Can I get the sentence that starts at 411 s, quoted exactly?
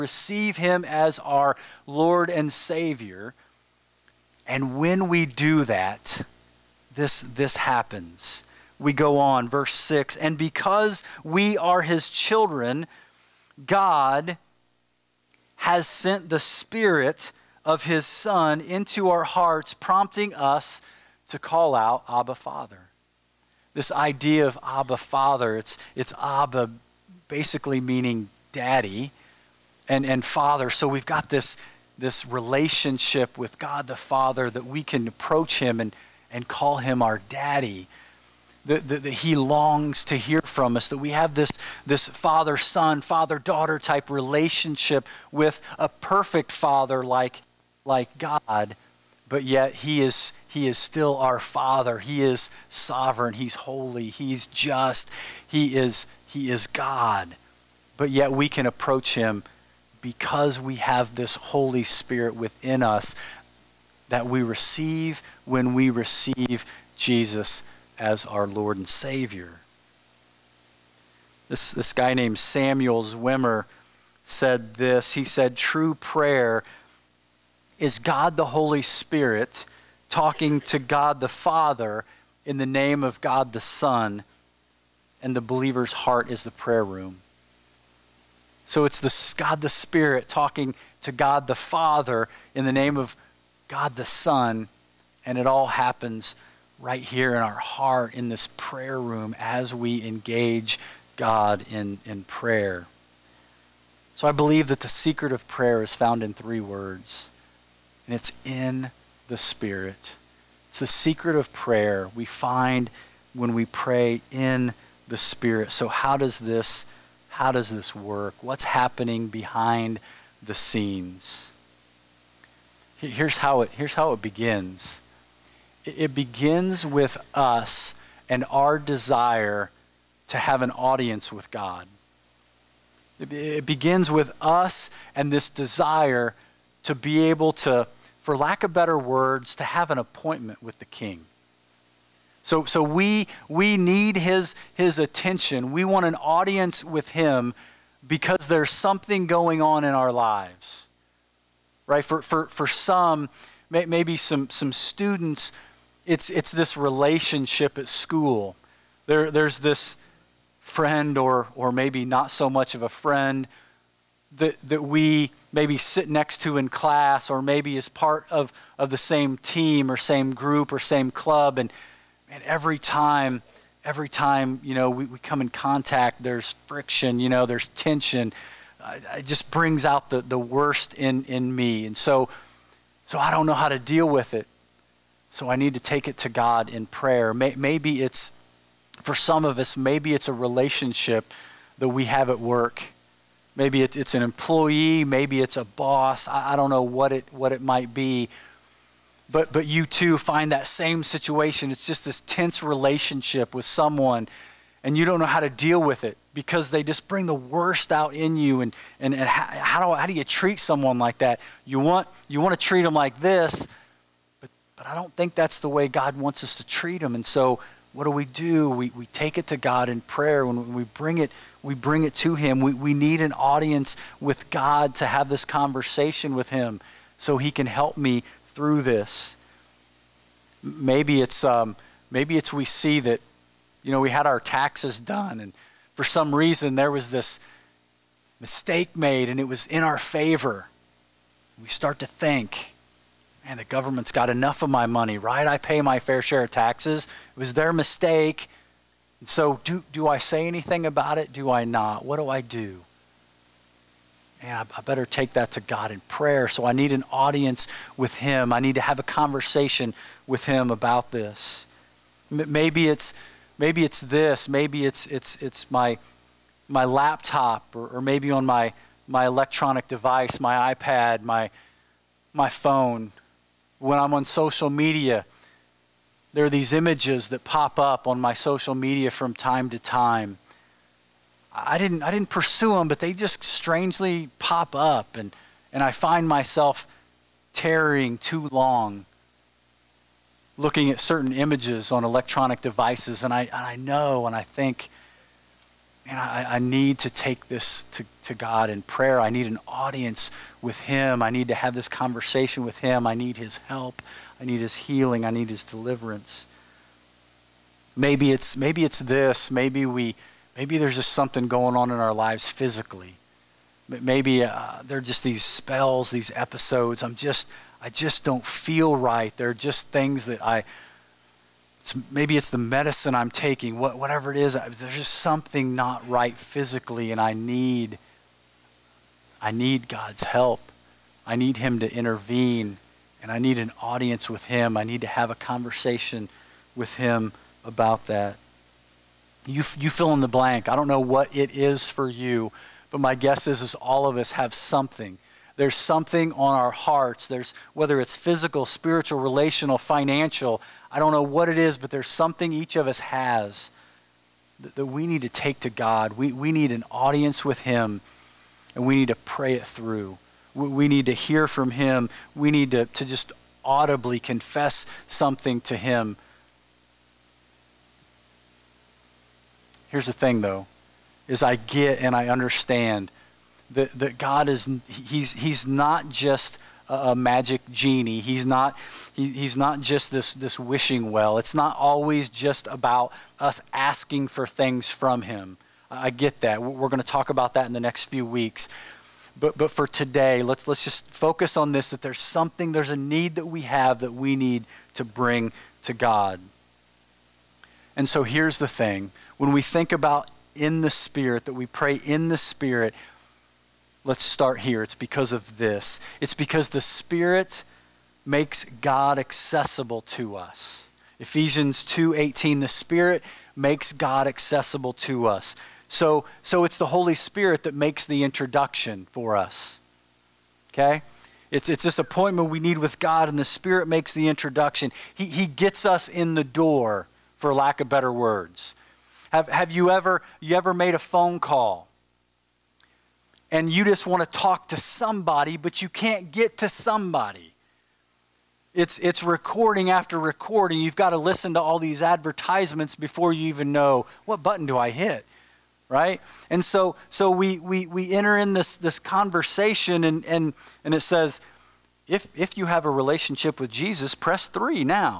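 Ephesians 2:18 the Spirit makes God accessible to us.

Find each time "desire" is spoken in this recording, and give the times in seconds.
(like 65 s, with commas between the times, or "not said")
128 s, 135 s.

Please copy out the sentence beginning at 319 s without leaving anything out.
They're just things that I, it's, maybe it's the medicine I'm taking, what, whatever it is.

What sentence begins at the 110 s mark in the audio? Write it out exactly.
It's the secret of prayer we find when we pray in the Spirit.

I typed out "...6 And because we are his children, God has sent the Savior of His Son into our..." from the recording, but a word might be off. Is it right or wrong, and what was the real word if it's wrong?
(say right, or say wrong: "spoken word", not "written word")
wrong: "Spirit", not "Savior".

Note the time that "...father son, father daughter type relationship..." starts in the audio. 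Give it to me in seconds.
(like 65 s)
42 s.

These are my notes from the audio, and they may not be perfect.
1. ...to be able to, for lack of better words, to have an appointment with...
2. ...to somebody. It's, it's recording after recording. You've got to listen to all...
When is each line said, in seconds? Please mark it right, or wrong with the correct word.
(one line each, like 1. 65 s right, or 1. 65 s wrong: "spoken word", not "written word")
1. 136 s right
2. 436 s right.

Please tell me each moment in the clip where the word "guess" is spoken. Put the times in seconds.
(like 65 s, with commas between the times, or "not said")
343 s.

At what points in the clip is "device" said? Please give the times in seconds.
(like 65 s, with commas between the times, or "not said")
269 s, 292 s.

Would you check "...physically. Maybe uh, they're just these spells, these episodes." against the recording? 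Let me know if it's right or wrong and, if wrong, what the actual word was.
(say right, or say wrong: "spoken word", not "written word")
right.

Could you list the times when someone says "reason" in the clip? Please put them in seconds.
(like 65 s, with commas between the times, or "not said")
236 s.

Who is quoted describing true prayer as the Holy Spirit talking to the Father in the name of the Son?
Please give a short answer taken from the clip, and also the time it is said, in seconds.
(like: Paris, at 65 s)
Samuel Zwemer, at 72 s.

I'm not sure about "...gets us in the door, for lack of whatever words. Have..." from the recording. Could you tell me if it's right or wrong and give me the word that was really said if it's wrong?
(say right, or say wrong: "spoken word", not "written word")
wrong: "better", not "whatever".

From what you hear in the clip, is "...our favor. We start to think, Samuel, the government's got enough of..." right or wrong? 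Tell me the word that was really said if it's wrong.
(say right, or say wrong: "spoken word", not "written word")
wrong: "Man", not "Samuel".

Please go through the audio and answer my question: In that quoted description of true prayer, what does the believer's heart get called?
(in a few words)
the prayer room.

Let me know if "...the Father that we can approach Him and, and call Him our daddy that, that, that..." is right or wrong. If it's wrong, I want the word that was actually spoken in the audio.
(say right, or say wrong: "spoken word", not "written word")
right.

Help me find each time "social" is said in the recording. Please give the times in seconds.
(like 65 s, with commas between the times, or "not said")
274 s, 278 s.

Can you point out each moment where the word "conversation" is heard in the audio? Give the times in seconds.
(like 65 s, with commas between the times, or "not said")
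225 s, 259 s, 301 s, 335 s, 448 s.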